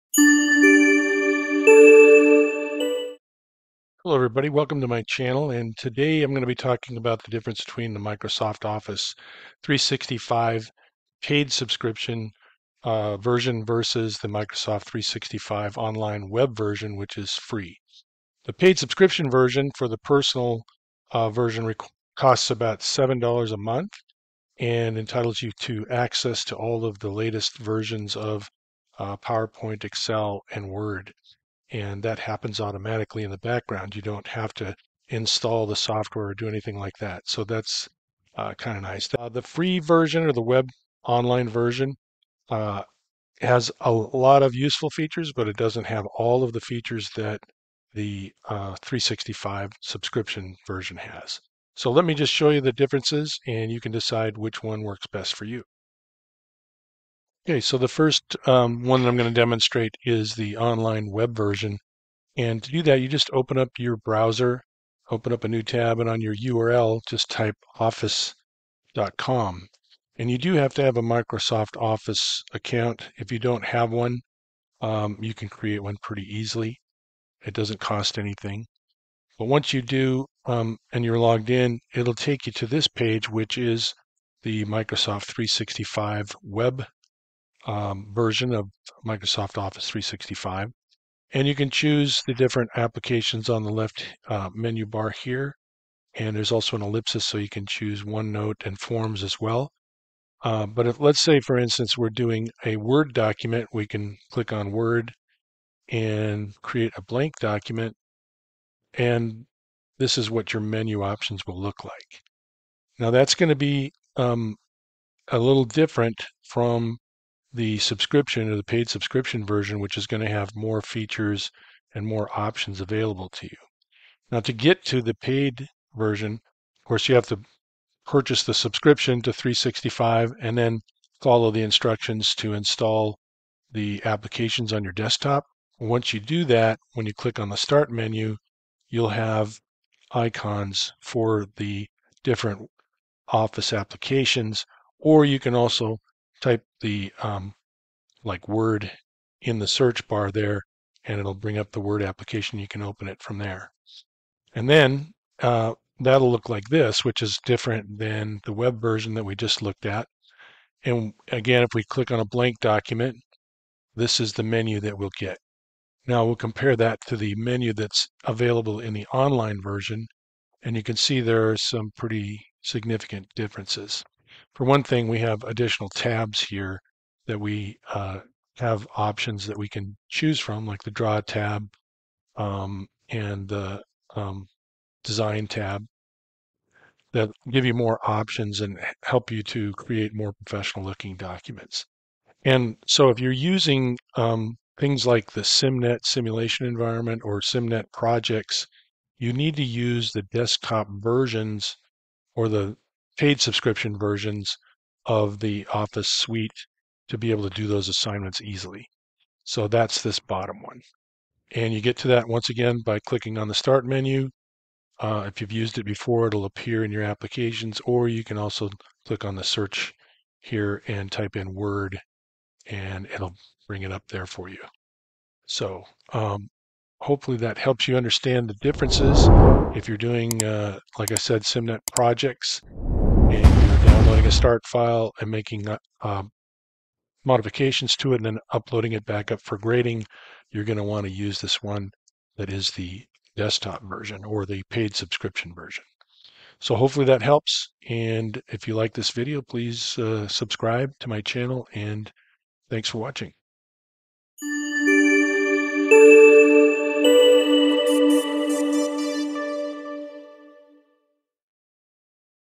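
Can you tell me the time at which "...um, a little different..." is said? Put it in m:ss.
1:54.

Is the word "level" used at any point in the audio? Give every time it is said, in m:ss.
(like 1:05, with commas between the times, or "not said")
not said.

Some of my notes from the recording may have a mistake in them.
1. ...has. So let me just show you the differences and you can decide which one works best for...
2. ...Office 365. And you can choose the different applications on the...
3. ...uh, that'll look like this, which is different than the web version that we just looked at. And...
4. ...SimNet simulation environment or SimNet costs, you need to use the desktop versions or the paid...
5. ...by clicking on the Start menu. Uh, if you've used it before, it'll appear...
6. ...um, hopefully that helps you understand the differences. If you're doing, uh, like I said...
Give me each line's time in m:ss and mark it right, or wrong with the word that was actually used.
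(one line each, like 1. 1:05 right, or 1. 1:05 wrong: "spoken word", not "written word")
1. 0:50 right
2. 1:29 right
3. 2:35 right
4. 3:15 wrong: "projects", not "costs"
5. 3:32 right
6. 3:46 right.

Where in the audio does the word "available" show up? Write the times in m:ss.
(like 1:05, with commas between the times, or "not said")
2:02, 2:48.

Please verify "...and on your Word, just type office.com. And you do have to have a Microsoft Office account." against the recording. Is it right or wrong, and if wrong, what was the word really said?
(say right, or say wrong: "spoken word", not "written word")
wrong: "URL", not "Word".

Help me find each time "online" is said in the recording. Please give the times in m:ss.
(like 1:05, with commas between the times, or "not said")
0:15, 0:41, 1:00, 2:49.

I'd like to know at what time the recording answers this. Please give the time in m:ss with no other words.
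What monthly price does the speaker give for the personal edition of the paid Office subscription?
0:22.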